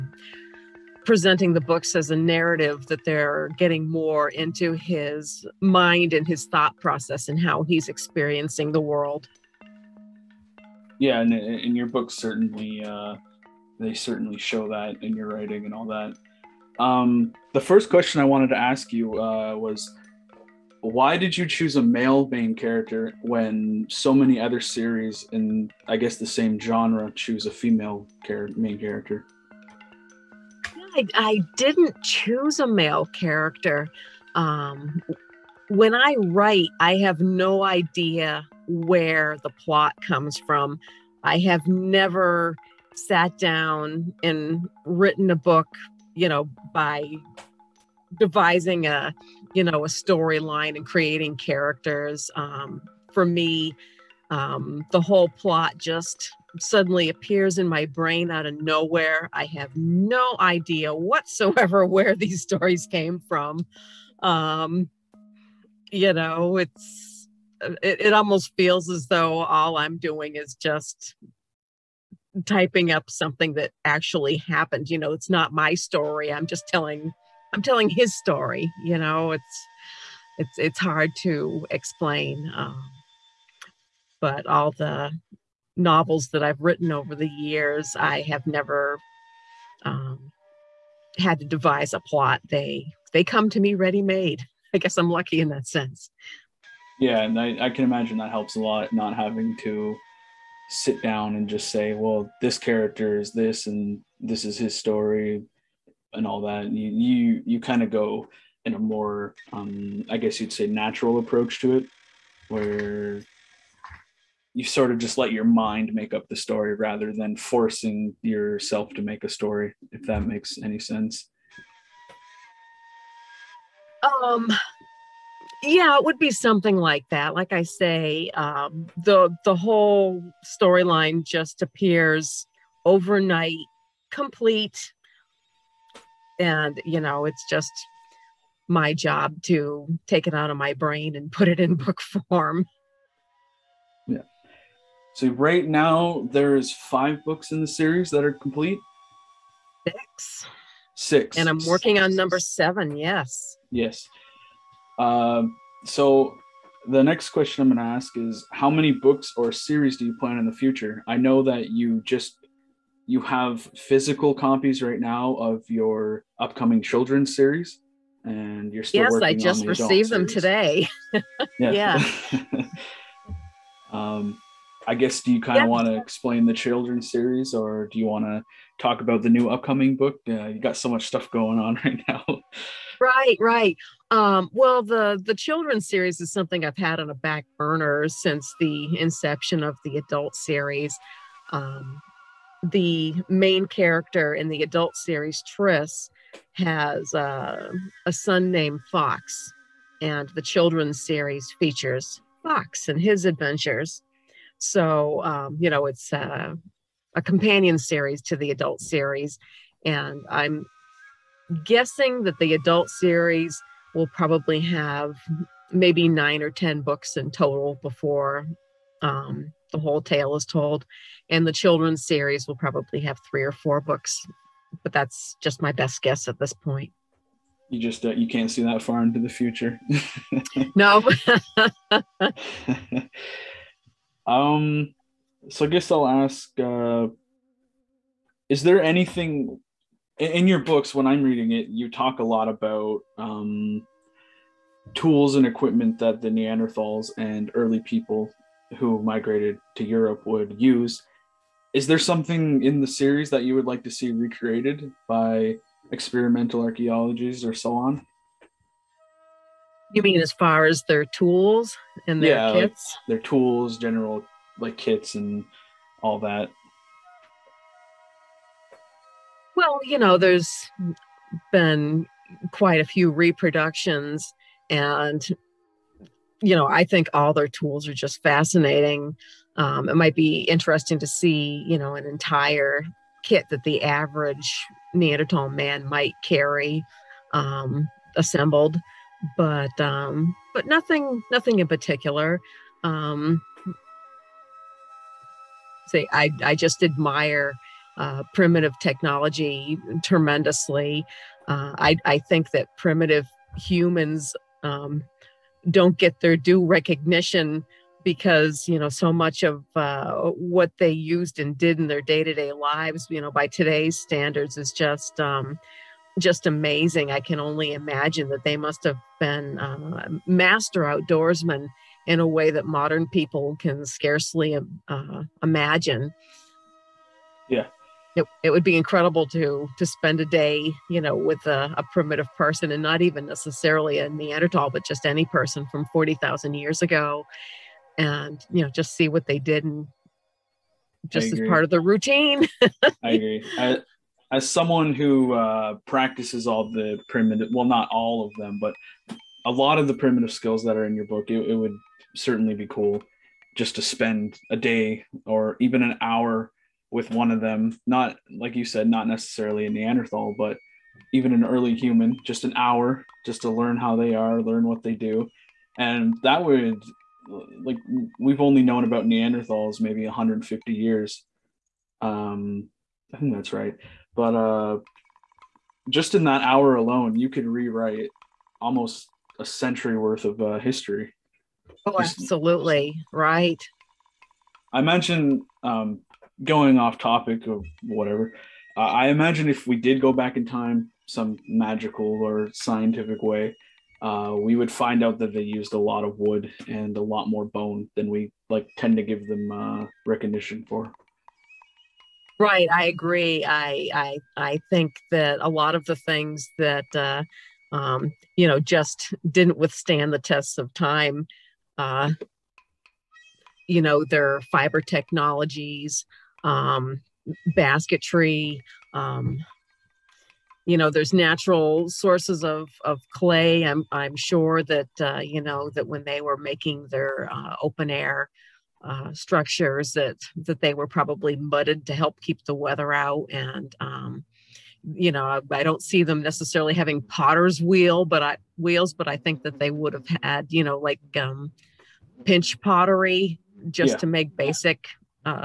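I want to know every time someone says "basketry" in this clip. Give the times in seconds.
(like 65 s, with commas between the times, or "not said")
417 s.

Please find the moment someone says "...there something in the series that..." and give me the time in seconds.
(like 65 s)
251 s.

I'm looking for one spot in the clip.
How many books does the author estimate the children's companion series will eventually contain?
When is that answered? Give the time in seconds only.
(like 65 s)
223 s.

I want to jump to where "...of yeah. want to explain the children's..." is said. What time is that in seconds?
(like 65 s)
175 s.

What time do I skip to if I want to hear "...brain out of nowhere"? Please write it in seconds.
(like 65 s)
57 s.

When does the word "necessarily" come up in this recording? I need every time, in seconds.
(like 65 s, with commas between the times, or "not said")
333 s, 359 s, 436 s.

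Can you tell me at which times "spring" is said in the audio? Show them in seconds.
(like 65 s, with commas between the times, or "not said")
not said.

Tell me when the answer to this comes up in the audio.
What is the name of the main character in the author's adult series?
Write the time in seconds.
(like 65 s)
195 s.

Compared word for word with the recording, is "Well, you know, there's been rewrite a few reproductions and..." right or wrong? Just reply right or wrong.
wrong.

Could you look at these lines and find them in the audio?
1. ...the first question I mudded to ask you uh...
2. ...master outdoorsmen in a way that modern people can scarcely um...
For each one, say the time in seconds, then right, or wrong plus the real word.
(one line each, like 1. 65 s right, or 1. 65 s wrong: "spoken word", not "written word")
1. 17 s wrong: "wanted", not "mudded"
2. 320 s right.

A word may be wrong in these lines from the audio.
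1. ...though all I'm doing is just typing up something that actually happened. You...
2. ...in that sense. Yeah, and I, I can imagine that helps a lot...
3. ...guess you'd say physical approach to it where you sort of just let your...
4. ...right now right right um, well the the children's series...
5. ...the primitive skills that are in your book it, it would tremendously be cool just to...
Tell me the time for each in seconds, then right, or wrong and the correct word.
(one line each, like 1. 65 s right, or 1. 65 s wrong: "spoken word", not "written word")
1. 69 s right
2. 95 s right
3. 110 s wrong: "natural", not "physical"
4. 181 s right
5. 349 s wrong: "certainly", not "tremendously".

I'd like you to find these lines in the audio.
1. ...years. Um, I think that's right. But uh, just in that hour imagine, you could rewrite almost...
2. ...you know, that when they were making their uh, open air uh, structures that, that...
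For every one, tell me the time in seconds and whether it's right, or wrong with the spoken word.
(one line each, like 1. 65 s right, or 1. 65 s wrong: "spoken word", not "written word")
1. 370 s wrong: "alone", not "imagine"
2. 425 s right.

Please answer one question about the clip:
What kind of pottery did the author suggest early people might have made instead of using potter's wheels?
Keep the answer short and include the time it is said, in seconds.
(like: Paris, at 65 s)
Pinch pottery, at 442 s.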